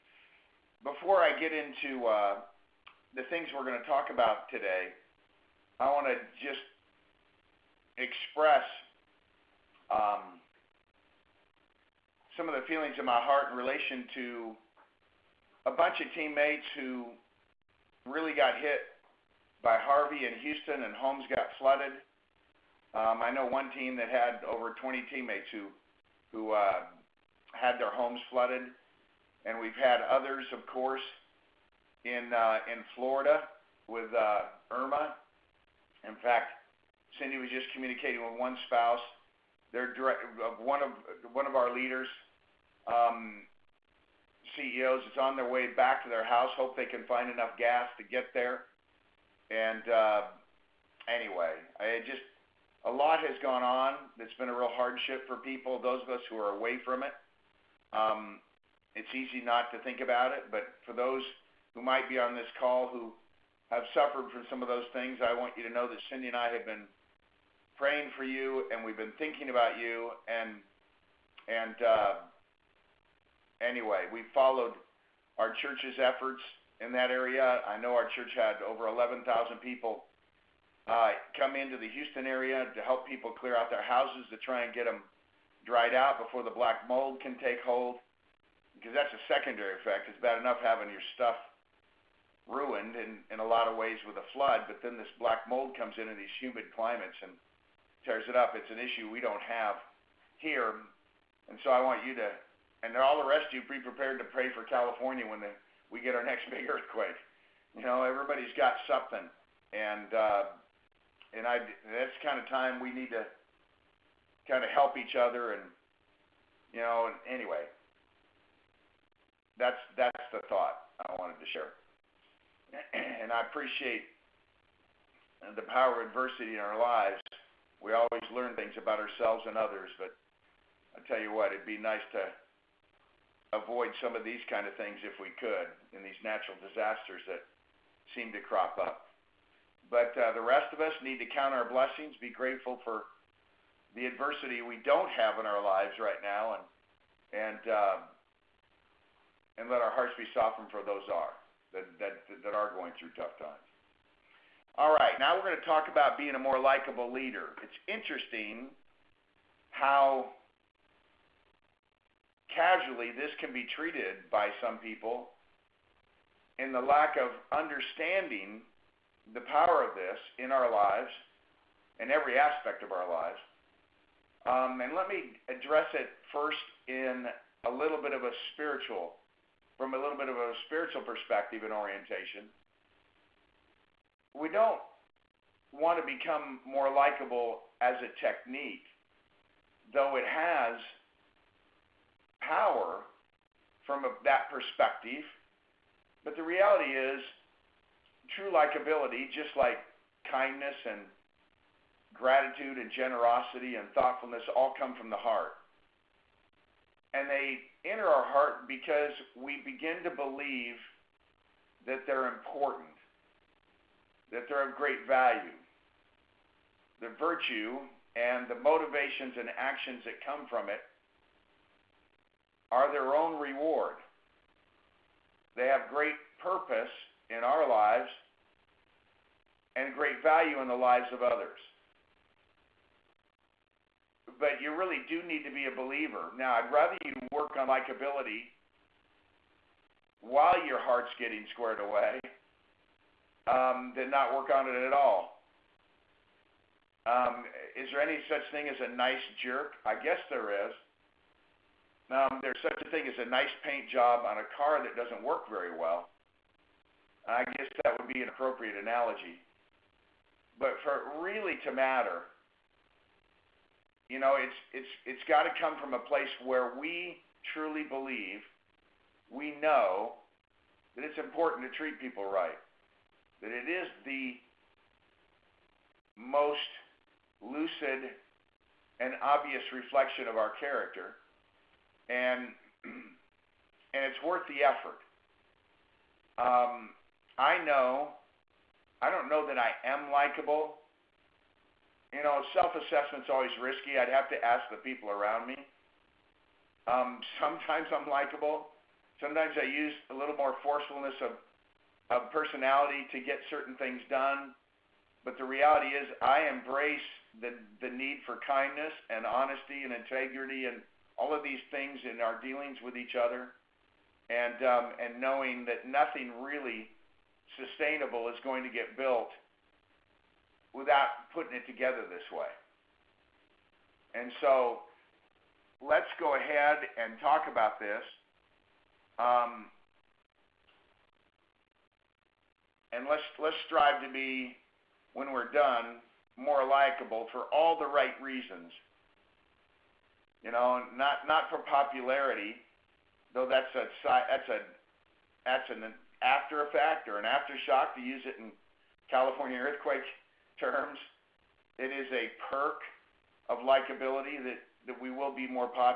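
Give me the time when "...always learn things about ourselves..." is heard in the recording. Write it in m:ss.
2:07.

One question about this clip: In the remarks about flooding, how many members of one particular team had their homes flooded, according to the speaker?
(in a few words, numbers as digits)
over 20.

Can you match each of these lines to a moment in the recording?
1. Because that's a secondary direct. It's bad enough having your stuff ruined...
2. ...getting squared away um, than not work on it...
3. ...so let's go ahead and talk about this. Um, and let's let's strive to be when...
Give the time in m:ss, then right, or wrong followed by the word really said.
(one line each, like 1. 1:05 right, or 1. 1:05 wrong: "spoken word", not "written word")
1. 1:28 wrong: "effect", not "direct"
2. 4:01 right
3. 5:24 right.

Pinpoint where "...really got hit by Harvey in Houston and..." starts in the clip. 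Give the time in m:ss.
0:18.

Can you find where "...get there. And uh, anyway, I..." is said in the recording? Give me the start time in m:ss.
0:48.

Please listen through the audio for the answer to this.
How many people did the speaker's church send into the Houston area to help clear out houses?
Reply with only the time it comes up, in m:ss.
1:18.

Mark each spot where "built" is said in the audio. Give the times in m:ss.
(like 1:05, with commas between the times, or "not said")
5:18.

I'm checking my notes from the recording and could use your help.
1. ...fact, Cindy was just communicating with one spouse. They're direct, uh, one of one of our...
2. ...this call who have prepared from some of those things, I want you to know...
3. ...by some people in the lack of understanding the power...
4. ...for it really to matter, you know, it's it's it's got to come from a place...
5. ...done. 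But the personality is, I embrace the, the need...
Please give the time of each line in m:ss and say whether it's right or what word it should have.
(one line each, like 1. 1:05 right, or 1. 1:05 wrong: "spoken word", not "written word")
1. 0:36 right
2. 1:02 wrong: "suffered", not "prepared"
3. 2:44 right
4. 4:20 right
5. 5:04 wrong: "reality", not "personality".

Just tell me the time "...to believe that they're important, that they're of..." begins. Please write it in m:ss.
3:30.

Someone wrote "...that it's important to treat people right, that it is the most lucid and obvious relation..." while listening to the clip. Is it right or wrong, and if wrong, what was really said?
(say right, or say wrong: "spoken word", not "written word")
wrong: "reflection", not "relation".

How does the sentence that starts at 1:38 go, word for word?
It's an issue we don't have here.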